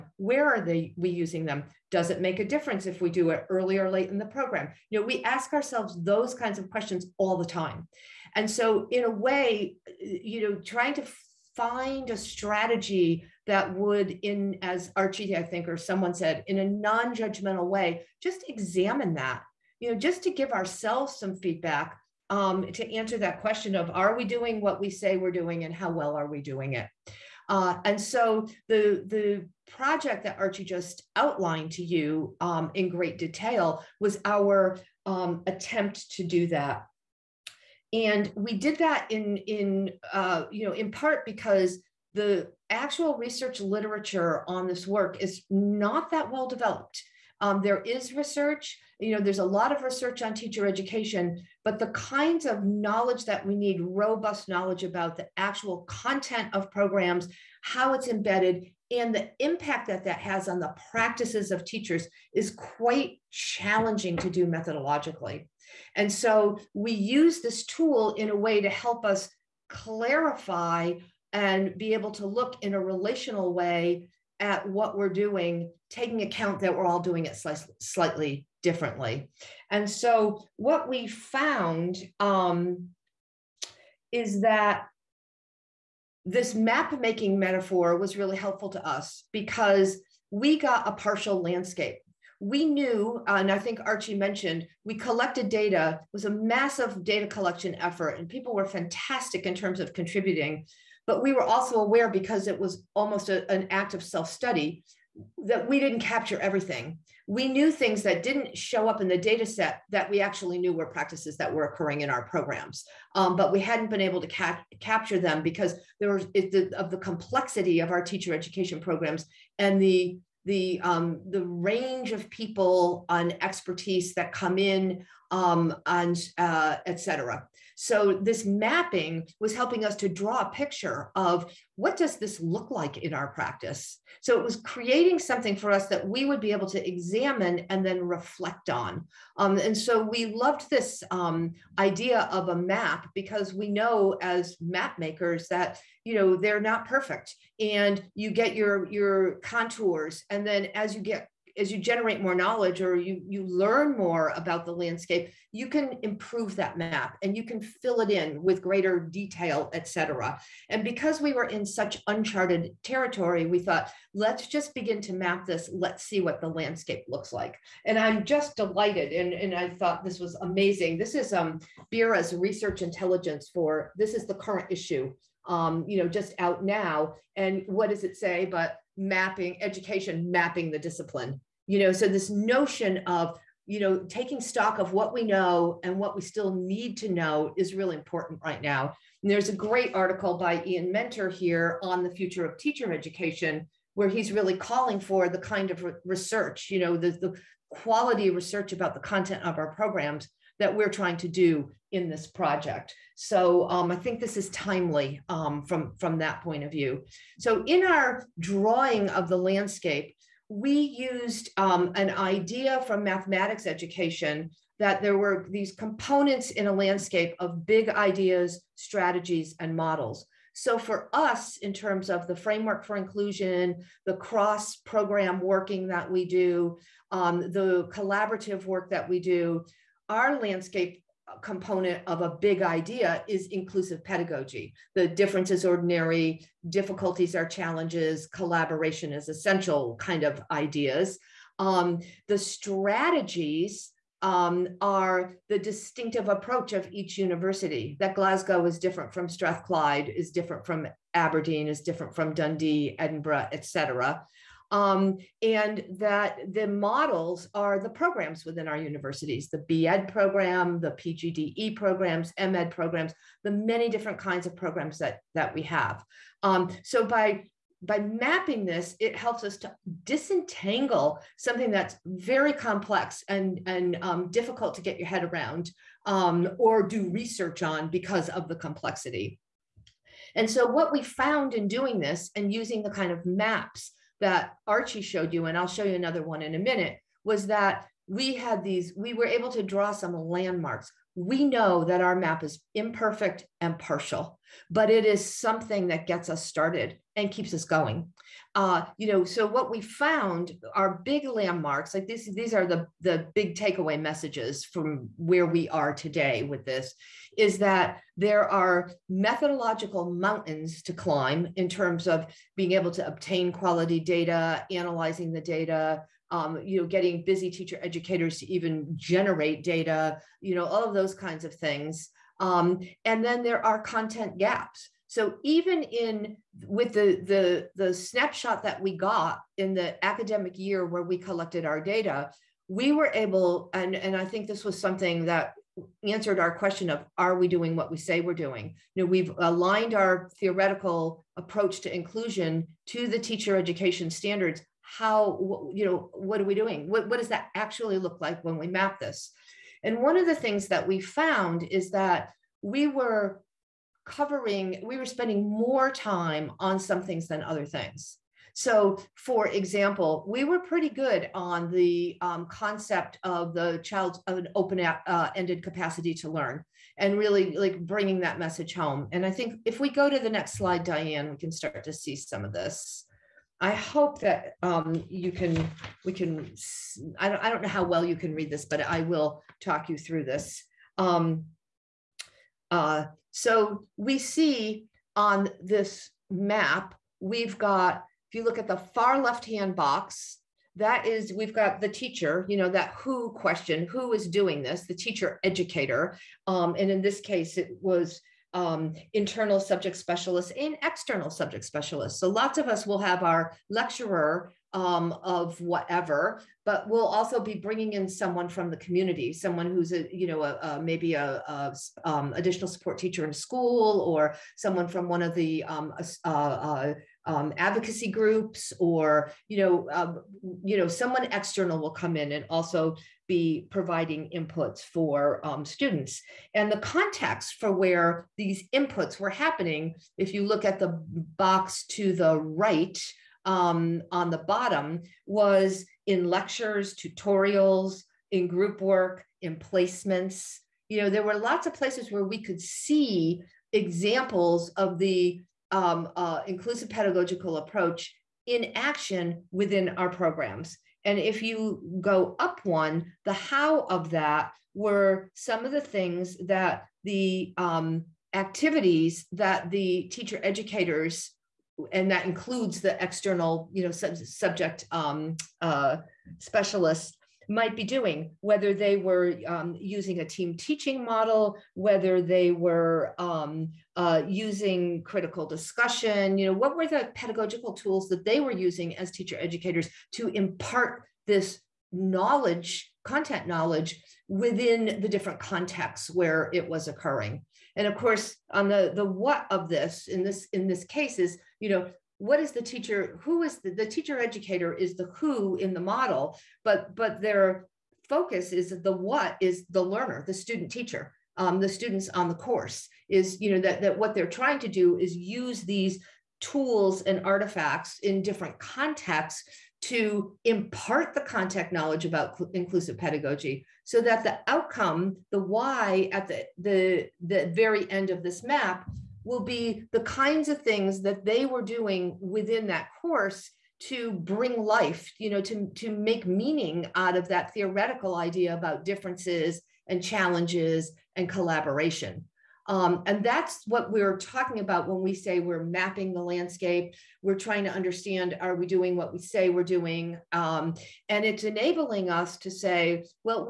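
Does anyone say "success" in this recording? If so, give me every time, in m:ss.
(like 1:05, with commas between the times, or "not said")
not said.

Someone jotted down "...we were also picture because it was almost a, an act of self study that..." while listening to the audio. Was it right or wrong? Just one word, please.
wrong.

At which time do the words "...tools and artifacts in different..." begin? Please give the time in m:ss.
8:26.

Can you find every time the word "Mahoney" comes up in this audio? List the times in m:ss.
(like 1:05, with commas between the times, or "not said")
not said.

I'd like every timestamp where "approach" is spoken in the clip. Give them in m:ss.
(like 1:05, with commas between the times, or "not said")
4:06, 5:41, 7:27.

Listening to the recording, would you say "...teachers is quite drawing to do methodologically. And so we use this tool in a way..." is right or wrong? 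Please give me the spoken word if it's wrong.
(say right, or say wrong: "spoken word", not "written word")
wrong: "challenging", not "drawing".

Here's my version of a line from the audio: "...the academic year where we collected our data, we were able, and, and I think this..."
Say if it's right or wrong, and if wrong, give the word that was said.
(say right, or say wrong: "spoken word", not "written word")
right.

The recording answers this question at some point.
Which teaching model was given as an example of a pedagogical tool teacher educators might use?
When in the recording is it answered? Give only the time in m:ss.
7:50.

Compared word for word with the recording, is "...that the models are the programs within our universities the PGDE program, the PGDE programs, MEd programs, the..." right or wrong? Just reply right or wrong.
wrong.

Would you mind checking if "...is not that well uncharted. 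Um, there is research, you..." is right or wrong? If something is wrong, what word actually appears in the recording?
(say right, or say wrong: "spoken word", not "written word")
wrong: "developed", not "uncharted".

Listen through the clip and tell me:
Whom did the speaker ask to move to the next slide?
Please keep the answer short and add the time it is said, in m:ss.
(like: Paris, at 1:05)
Dianne, at 6:10.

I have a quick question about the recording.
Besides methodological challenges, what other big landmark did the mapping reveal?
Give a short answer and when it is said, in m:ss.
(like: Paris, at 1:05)
content gaps, at 5:23.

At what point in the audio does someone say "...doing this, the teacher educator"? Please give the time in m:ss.
6:34.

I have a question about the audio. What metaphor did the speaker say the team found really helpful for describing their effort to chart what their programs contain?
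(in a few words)
map making.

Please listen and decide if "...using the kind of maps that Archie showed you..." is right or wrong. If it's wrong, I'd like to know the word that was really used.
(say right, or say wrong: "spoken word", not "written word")
right.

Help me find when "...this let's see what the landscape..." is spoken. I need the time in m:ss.
2:45.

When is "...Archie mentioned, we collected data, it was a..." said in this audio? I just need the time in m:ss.
1:33.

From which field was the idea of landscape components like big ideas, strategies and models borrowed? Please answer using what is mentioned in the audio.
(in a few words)
mathematics education.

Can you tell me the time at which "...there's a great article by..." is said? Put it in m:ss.
3:09.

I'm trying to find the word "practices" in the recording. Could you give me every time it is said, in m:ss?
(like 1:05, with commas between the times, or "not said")
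1:00, 1:50, 2:13.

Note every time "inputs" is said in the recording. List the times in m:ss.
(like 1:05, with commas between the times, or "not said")
7:04, 7:08.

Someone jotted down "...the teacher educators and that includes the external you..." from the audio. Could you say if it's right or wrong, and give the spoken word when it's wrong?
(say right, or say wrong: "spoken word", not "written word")
right.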